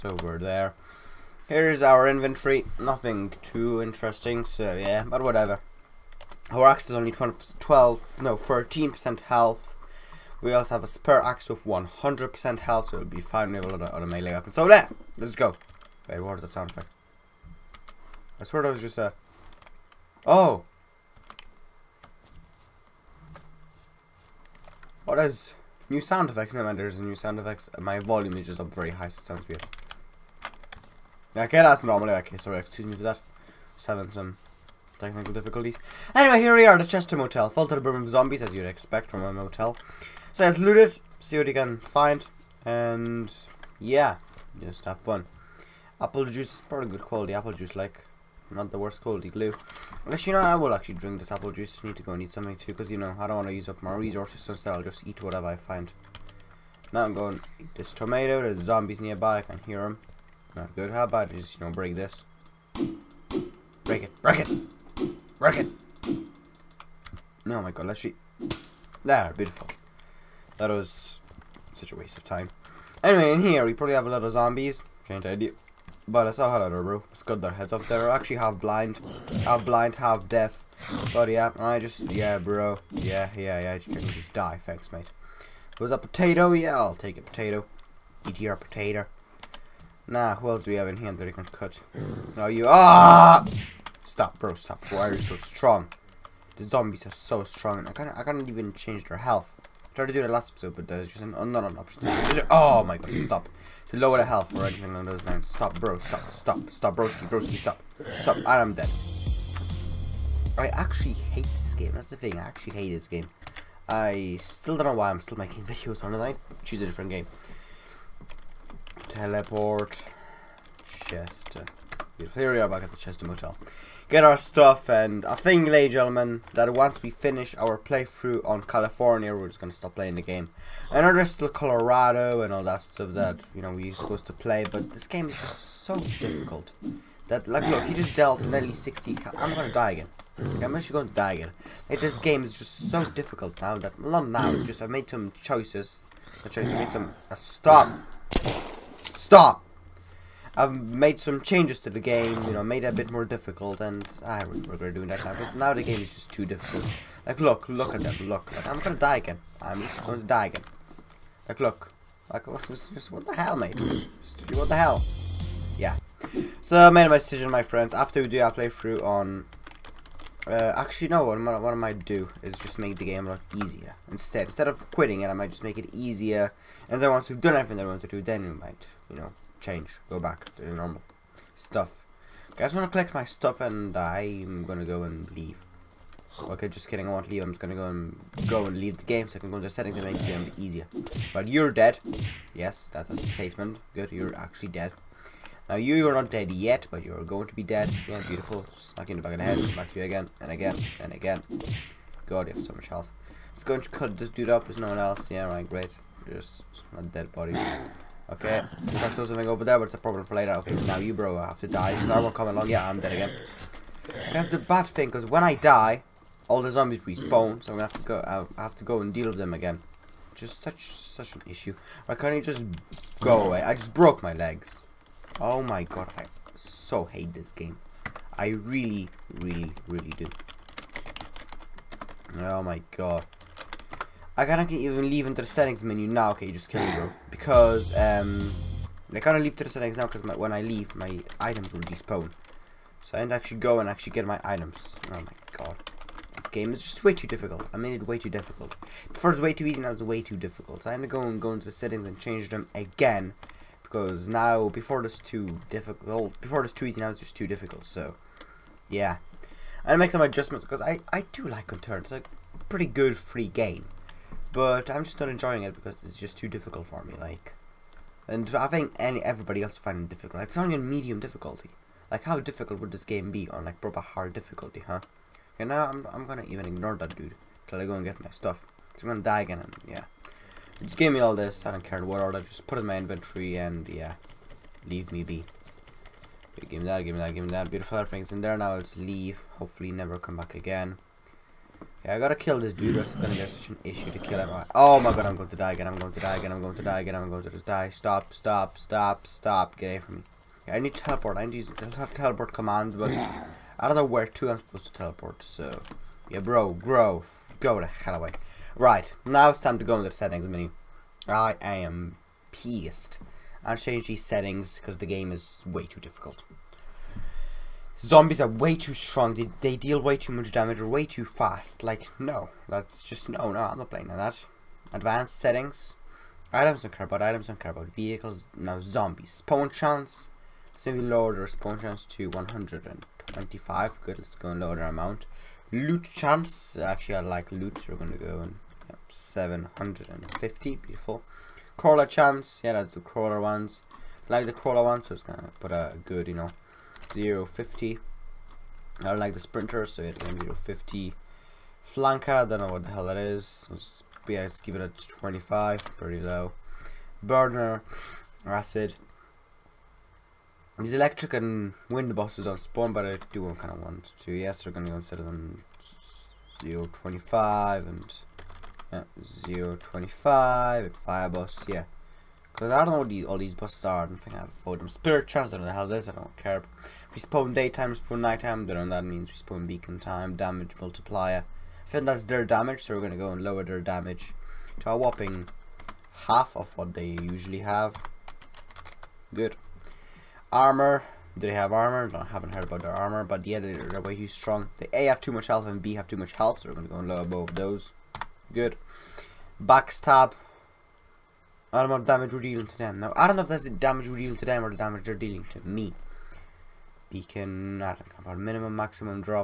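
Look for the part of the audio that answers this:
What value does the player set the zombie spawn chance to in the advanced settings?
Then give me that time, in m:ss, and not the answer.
5:32.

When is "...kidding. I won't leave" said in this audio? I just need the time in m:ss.
3:06.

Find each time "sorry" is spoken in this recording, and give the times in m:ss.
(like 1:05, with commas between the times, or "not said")
0:32.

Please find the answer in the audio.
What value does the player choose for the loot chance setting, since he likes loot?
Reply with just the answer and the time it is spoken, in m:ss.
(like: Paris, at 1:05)
750, at 5:39.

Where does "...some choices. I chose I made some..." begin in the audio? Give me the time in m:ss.
2:25.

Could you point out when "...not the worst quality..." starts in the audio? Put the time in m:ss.
0:48.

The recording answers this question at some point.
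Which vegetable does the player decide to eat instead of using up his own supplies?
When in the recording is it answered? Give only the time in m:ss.
0:57.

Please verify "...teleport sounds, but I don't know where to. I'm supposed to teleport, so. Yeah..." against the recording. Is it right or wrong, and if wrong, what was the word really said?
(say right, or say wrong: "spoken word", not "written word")
wrong: "commands", not "sounds".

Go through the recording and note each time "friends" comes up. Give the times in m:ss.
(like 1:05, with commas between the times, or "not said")
2:47.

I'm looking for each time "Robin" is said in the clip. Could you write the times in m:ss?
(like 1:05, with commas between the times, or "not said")
not said.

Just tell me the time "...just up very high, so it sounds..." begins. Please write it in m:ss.
0:28.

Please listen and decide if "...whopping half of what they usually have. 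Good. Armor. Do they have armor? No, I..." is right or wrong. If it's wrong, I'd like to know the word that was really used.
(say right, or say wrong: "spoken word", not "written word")
right.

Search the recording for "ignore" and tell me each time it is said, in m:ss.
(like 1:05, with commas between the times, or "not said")
4:36.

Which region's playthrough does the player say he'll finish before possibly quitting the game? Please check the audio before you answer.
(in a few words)
California.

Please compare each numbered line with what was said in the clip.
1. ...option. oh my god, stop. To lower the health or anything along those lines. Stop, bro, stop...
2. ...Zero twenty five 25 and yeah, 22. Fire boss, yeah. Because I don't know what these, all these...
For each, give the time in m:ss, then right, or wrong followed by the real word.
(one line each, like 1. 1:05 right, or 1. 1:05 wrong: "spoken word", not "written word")
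1. 1:41 right
2. 6:06 wrong: "25", not "22".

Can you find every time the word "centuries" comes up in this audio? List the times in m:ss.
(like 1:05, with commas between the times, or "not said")
not said.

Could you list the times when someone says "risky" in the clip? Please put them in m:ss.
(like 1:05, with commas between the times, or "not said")
not said.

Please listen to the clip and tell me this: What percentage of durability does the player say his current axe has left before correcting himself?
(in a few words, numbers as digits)
13%.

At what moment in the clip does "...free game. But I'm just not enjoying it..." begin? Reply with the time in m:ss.
4:23.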